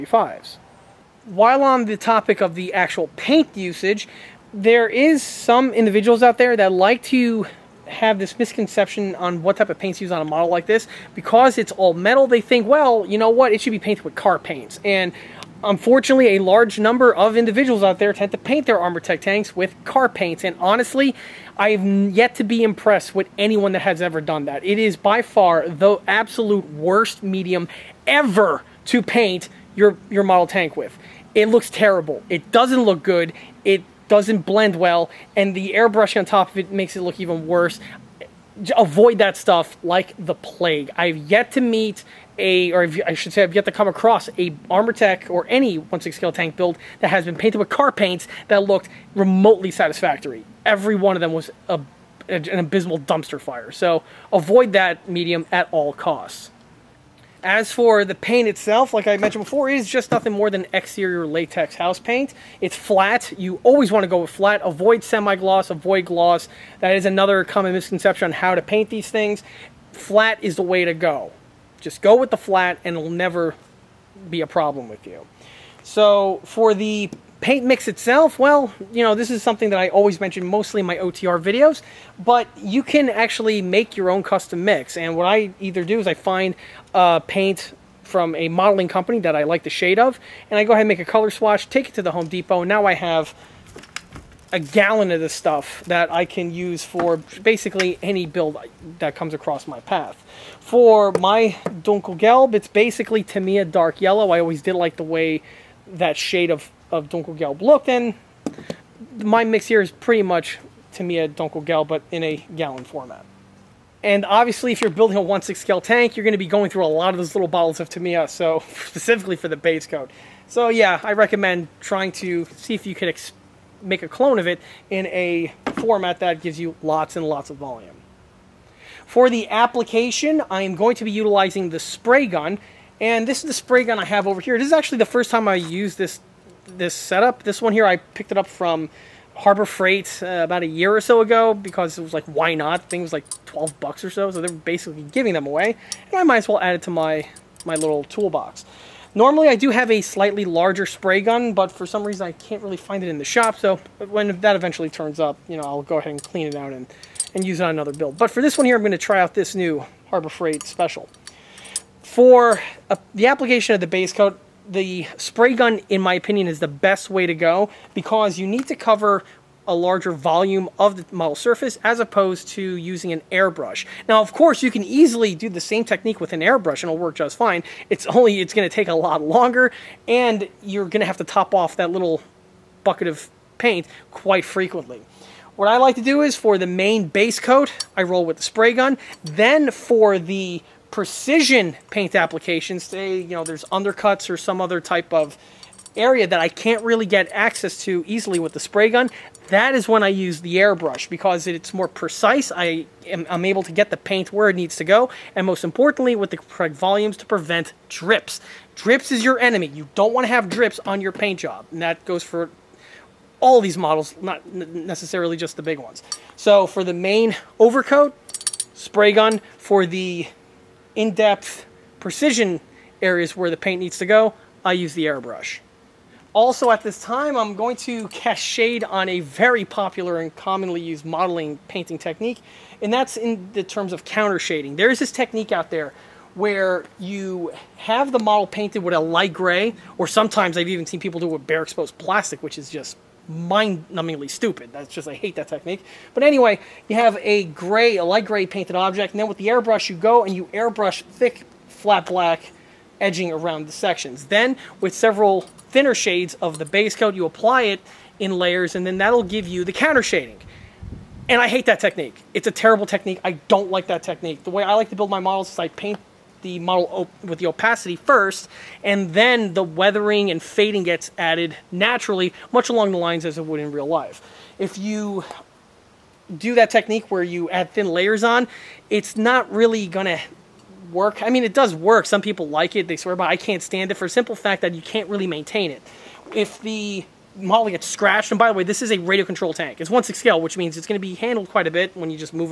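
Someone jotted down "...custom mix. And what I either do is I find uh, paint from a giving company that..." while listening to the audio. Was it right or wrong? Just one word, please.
wrong.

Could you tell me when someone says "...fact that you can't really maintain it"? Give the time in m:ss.
4:44.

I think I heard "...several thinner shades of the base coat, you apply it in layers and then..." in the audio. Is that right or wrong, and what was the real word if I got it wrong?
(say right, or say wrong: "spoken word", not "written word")
right.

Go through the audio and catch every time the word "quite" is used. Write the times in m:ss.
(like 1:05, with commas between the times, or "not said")
3:04, 4:51.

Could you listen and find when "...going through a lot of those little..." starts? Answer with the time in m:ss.
1:56.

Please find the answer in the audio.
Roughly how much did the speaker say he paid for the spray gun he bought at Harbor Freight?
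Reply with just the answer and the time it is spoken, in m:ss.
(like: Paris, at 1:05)
12 dollars, at 2:23.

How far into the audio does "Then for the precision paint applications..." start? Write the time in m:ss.
3:09.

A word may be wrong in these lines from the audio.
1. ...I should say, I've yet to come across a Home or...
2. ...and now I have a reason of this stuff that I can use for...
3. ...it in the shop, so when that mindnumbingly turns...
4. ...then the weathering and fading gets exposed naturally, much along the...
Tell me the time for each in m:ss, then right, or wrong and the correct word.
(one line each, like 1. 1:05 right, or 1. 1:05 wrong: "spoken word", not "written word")
1. 0:43 wrong: "Armortek", not "Home"
2. 1:32 wrong: "gallon", not "reason"
3. 2:33 wrong: "eventually", not "mindnumbingly"
4. 4:29 wrong: "added", not "exposed".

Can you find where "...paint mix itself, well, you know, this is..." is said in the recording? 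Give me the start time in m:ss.
1:17.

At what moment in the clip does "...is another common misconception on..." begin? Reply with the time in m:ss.
1:06.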